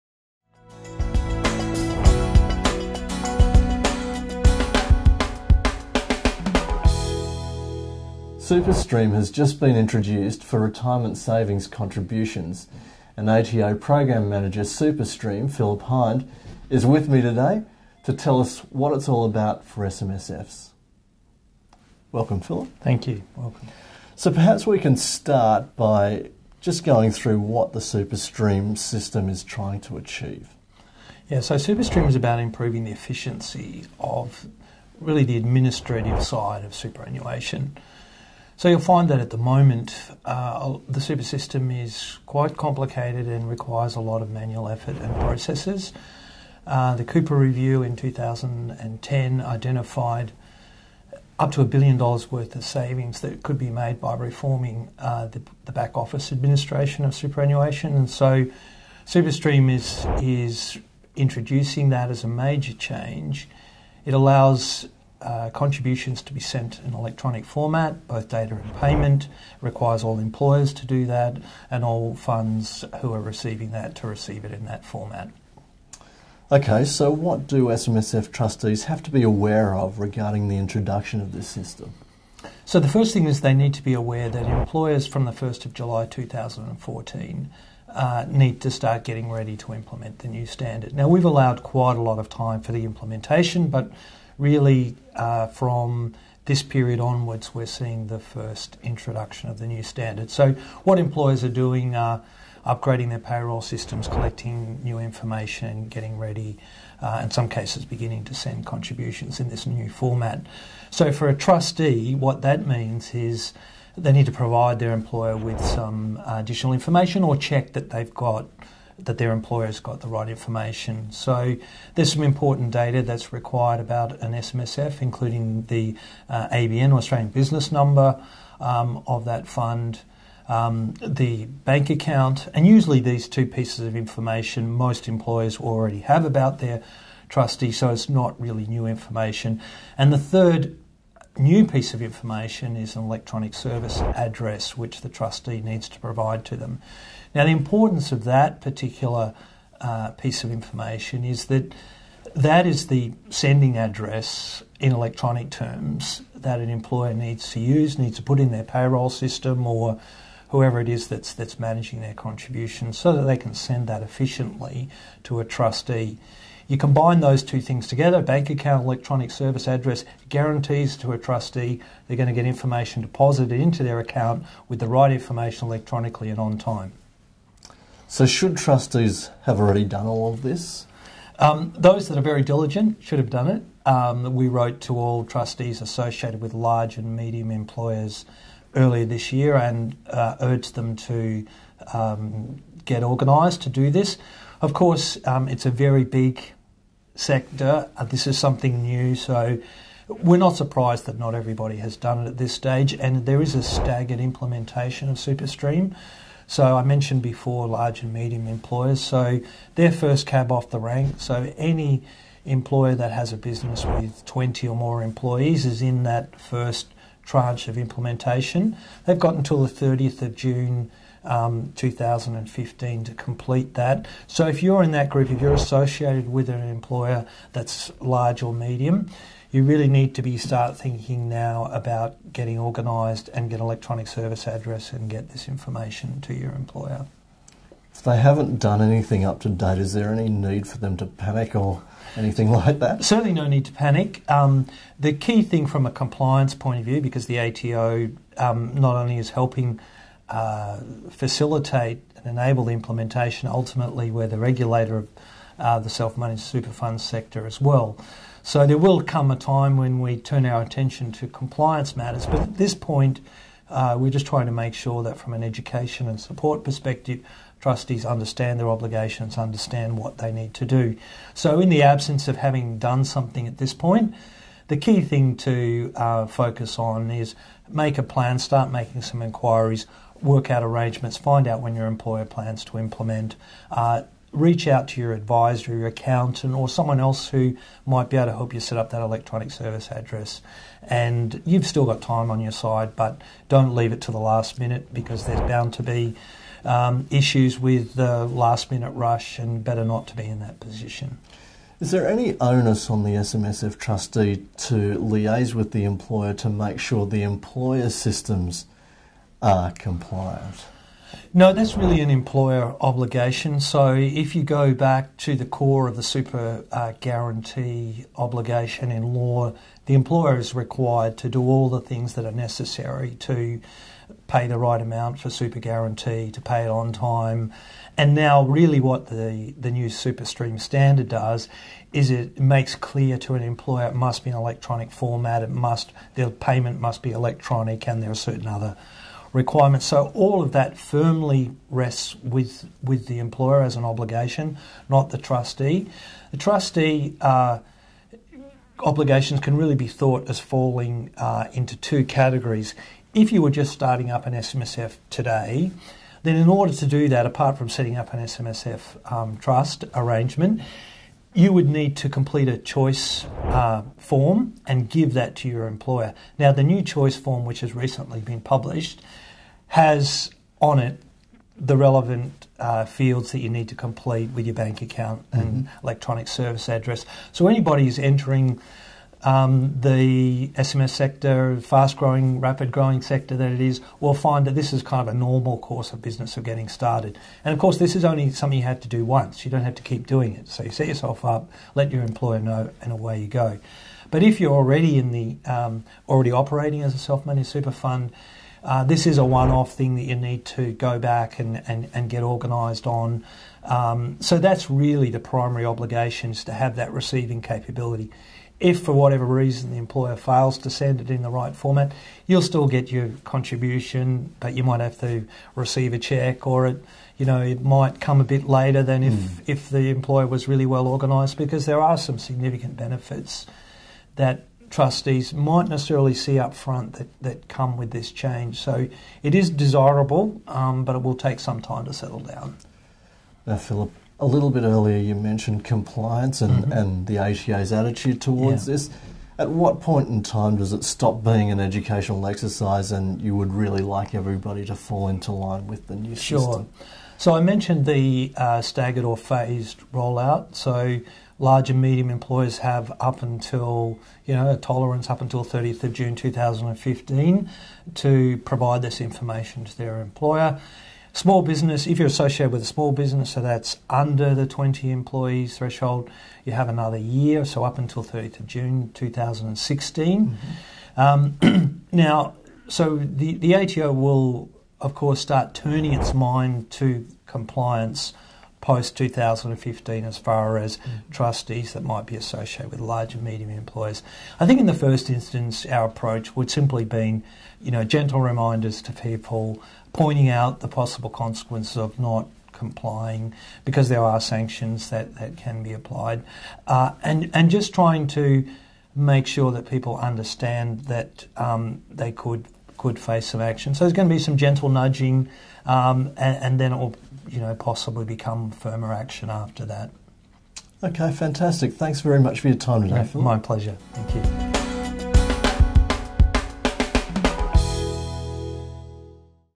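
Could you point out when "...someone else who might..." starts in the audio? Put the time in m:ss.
4:46.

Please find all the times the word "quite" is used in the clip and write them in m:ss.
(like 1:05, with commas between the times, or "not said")
0:42, 1:31.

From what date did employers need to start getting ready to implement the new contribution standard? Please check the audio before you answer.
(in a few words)
1 July 2014.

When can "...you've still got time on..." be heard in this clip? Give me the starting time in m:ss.
4:51.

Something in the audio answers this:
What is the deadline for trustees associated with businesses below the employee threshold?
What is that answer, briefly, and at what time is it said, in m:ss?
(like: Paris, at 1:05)
30 June 2016, at 7:48.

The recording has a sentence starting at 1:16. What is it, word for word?
Okay, so what do SMSF trustees have to be aware of regarding the introduction of this system?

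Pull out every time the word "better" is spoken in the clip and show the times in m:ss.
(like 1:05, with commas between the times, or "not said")
4:59.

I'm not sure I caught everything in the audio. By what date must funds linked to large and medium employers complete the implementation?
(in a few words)
30 June 2015.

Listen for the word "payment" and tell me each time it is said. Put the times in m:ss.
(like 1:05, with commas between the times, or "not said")
1:08, 5:36.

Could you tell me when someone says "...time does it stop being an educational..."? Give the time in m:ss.
7:20.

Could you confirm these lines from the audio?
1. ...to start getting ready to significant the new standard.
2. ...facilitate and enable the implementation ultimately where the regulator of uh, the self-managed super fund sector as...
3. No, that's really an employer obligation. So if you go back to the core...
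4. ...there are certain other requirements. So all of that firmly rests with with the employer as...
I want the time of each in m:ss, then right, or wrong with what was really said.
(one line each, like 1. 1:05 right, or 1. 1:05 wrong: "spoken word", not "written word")
1. 1:28 wrong: "implement", not "significant"
2. 4:11 right
3. 5:11 right
4. 5:38 right.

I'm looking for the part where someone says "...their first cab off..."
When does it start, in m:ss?
3:29.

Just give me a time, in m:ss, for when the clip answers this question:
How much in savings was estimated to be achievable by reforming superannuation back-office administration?
0:51.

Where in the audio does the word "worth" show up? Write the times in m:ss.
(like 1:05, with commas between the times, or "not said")
0:52.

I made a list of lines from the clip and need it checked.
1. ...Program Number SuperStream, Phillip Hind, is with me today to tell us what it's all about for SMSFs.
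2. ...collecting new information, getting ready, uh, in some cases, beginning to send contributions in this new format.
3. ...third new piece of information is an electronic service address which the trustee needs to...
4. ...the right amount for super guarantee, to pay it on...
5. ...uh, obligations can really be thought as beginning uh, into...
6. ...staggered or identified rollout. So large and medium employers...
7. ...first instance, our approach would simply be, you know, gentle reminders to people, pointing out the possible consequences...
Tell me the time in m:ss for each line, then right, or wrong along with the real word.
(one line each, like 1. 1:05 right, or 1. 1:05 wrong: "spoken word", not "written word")
1. 0:13 wrong: "Manager", not "Number"
2. 1:44 right
3. 2:20 right
4. 5:24 right
5. 5:47 wrong: "falling", not "beginning"
6. 7:28 wrong: "phased", not "identified"
7. 8:04 right.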